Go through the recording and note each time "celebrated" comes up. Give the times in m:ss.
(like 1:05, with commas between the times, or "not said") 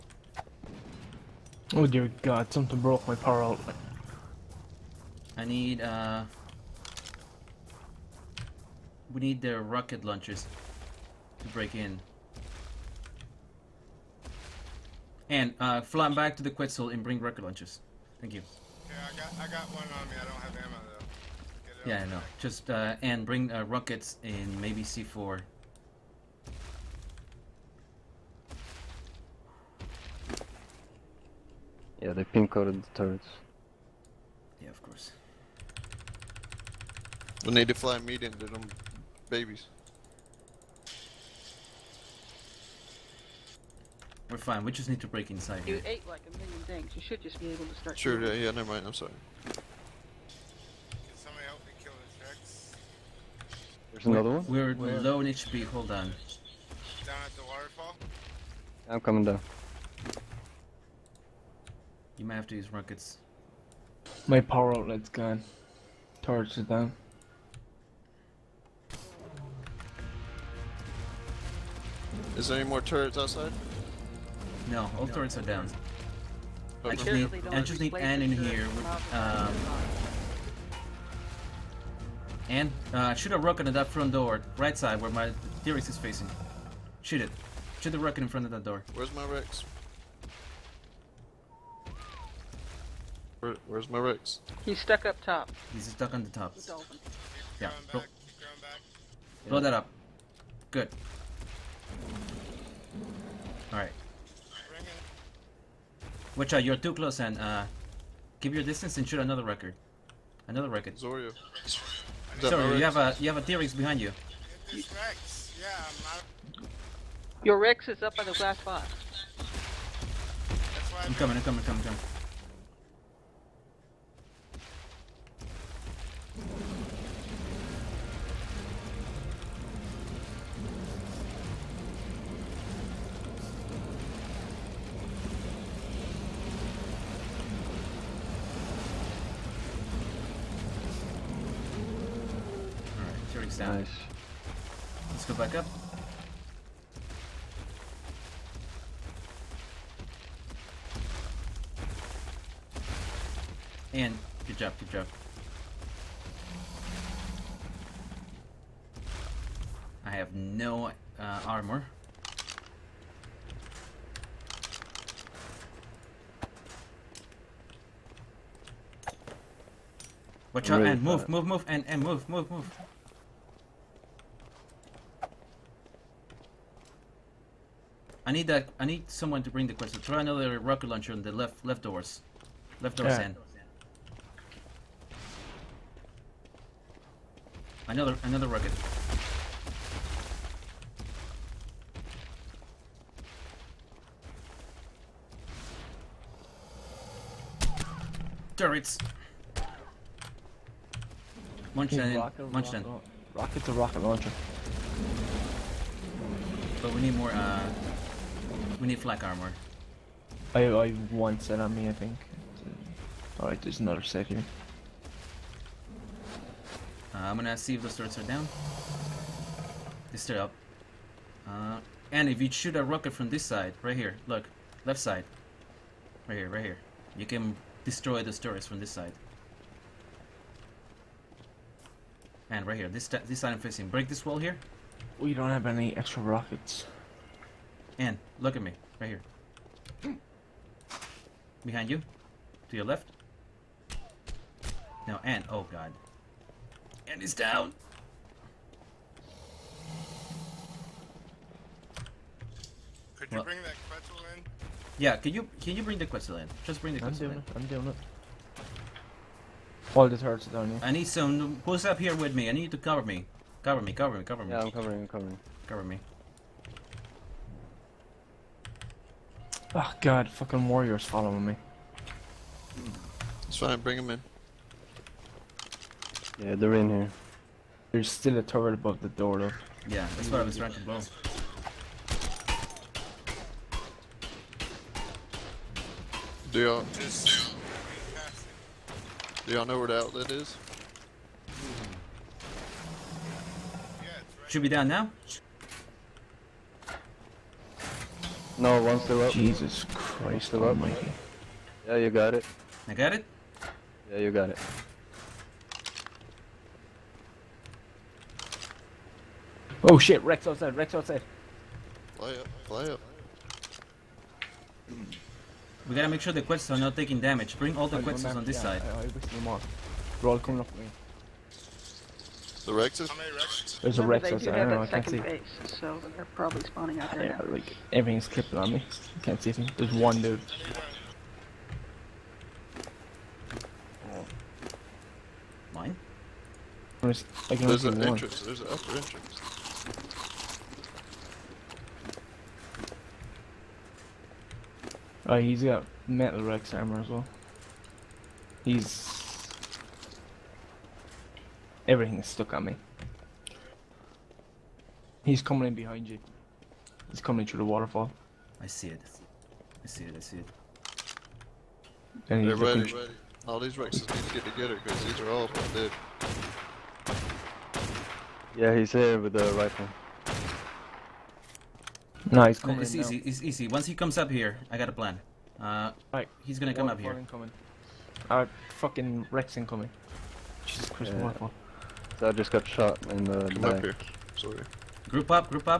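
not said.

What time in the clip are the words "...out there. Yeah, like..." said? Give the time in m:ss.
5:27.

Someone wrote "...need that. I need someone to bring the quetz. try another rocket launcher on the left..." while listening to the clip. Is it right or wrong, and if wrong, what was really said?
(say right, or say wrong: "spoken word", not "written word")
right.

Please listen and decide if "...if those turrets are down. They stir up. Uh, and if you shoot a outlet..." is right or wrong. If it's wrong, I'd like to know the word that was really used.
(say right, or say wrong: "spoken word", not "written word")
wrong: "rocket", not "outlet".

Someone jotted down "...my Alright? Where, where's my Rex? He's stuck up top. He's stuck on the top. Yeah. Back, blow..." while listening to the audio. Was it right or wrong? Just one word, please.
wrong.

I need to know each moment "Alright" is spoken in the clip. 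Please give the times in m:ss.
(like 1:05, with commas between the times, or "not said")
1:43, 3:33.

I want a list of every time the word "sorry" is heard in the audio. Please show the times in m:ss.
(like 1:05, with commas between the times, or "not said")
0:48, 1:50, 6:24.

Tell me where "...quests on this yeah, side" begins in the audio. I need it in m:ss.
5:18.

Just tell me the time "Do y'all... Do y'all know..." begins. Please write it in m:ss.
4:46.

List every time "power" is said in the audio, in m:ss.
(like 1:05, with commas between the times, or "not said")
0:03, 1:04.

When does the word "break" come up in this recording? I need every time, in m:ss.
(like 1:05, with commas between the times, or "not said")
0:11, 0:45, 3:53.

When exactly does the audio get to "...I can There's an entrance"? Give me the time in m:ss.
5:37.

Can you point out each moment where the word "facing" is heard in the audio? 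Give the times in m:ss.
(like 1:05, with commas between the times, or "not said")
1:25, 3:53.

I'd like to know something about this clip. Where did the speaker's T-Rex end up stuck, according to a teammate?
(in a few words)
on the glass box.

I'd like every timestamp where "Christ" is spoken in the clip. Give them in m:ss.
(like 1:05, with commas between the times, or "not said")
4:59, 6:20.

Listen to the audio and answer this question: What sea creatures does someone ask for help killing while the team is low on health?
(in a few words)
sharks.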